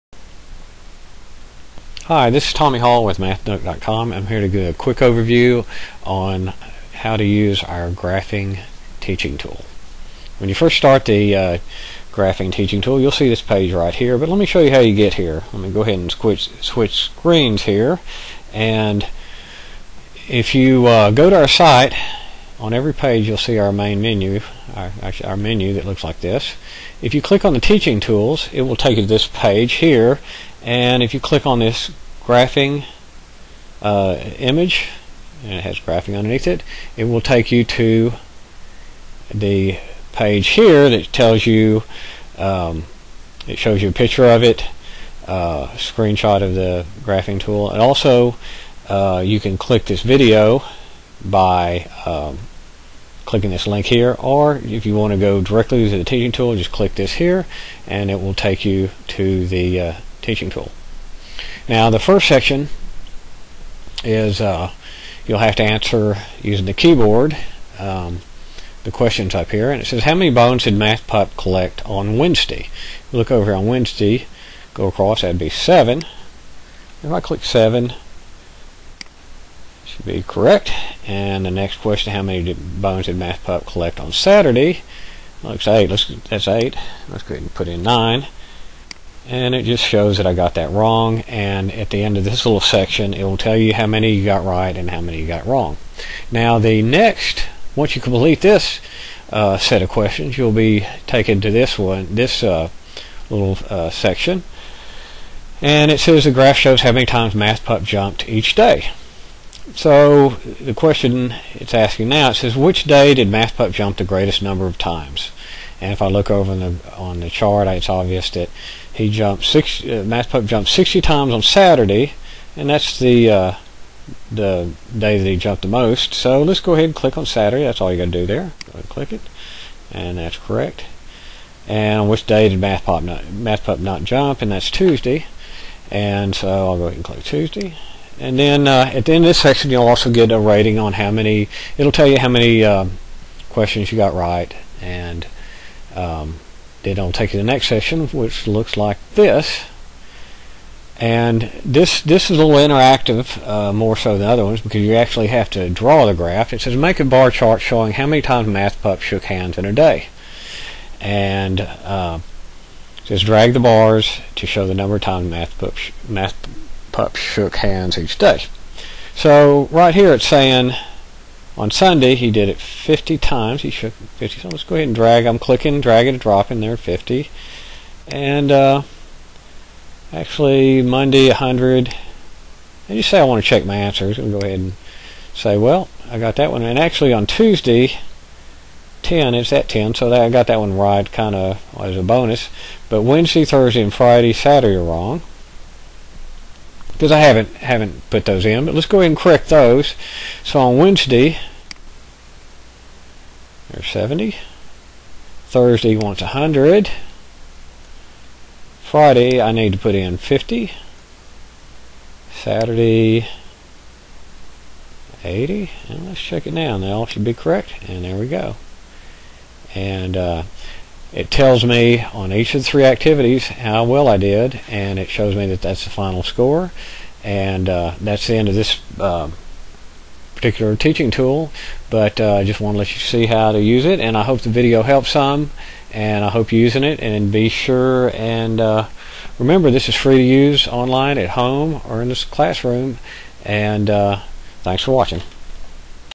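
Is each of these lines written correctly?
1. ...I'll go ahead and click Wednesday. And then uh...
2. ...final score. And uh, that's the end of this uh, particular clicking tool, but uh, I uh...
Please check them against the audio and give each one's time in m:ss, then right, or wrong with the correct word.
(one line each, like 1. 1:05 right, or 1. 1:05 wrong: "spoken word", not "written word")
1. 2:16 wrong: "Tuesday", not "Wednesday"
2. 3:45 wrong: "teaching", not "clicking".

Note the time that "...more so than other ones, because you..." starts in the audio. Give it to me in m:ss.
2:33.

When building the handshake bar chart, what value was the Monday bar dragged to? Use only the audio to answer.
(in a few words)
100.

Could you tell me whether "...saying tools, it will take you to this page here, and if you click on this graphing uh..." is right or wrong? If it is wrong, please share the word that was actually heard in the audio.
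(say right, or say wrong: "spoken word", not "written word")
wrong: "teaching", not "saying".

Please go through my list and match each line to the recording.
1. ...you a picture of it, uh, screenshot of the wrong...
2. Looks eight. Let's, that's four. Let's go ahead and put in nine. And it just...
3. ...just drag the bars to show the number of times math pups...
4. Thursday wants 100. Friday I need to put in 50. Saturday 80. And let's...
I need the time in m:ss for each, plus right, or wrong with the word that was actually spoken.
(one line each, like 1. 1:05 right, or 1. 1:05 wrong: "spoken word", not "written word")
1. 0:43 wrong: "graphing", not "wrong"
2. 1:25 wrong: "eight", not "four"
3. 2:43 right
4. 3:25 right.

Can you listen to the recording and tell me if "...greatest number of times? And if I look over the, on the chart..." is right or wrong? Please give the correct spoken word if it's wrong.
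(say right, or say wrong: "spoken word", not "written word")
right.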